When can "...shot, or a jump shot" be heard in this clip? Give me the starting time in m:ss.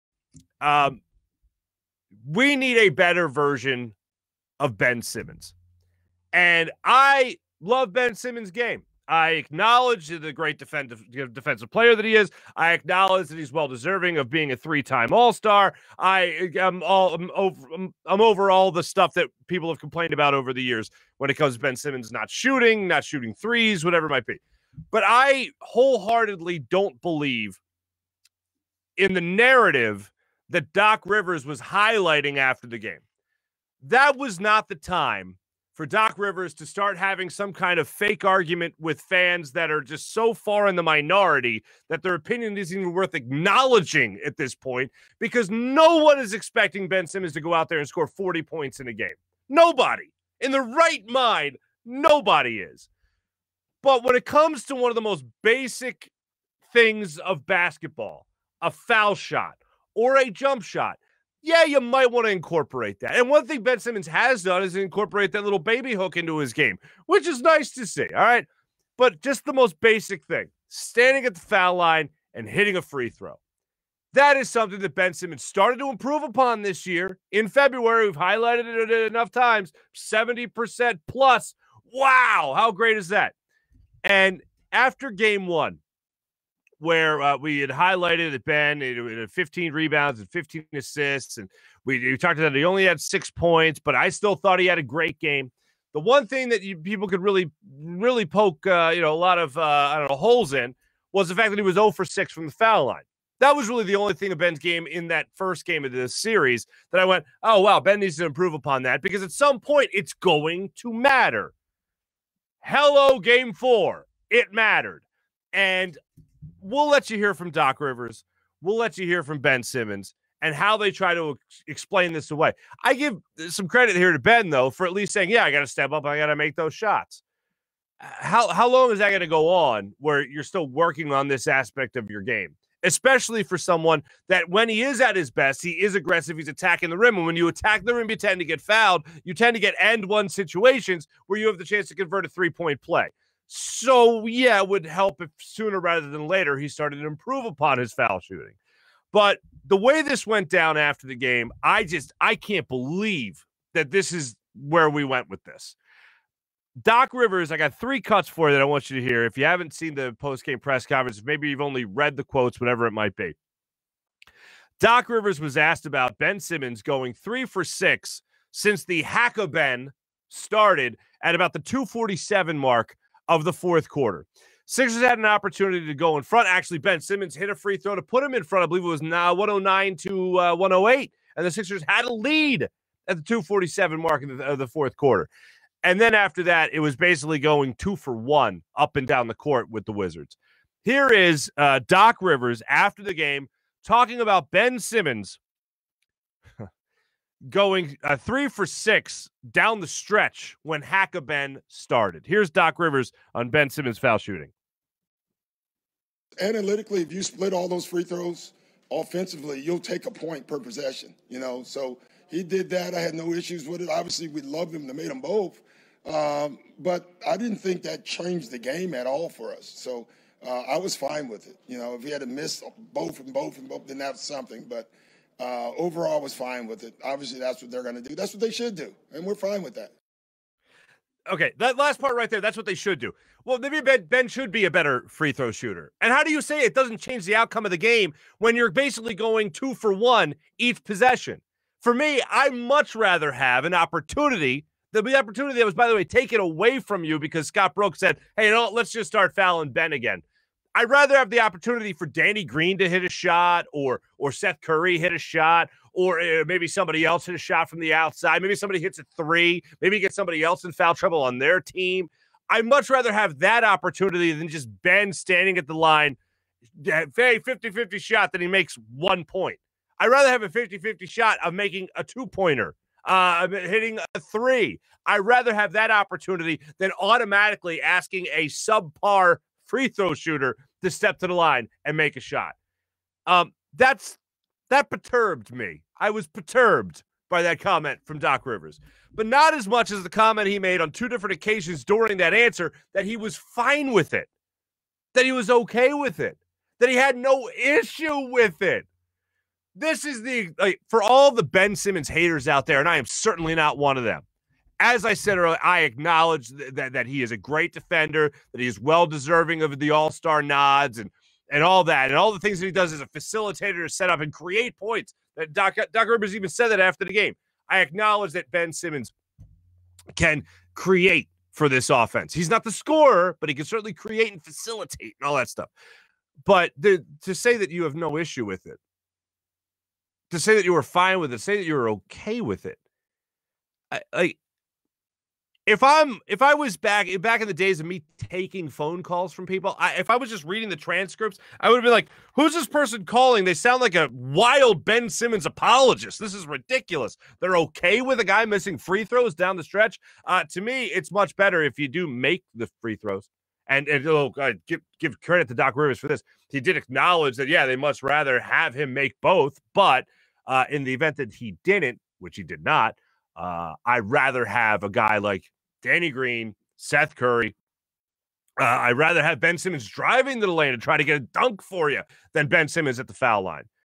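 0:59.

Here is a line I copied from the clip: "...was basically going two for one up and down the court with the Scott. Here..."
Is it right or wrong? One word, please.
wrong.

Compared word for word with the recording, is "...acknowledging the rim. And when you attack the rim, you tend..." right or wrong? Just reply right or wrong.
wrong.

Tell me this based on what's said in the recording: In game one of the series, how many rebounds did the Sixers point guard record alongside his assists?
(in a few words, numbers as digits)
15.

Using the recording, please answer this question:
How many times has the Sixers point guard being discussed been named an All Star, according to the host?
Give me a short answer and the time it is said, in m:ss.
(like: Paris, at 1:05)
3, at 0:14.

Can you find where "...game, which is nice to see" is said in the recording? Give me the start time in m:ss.
1:06.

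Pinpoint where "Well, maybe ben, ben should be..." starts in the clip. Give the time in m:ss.
3:53.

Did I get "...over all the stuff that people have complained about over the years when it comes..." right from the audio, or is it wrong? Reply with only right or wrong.
right.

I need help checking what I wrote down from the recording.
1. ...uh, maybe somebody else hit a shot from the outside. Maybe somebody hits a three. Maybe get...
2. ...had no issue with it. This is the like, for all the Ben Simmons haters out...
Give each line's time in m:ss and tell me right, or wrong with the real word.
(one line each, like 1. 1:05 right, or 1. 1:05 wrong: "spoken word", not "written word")
1. 4:16 right
2. 4:56 right.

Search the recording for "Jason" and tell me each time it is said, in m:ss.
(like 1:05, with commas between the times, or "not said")
not said.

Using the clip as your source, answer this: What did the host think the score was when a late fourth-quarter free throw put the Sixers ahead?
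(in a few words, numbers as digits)
109 to 108.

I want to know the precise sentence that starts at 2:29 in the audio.
But the way this went down after the game, I just I can't believe that this is where we went with this.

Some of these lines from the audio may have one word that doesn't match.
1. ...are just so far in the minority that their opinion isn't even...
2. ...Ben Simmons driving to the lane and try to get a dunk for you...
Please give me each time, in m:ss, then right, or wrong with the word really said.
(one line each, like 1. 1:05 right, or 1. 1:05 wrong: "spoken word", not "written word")
1. 0:39 right
2. 6:09 right.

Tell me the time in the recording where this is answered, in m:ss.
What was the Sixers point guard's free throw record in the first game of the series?
1:41.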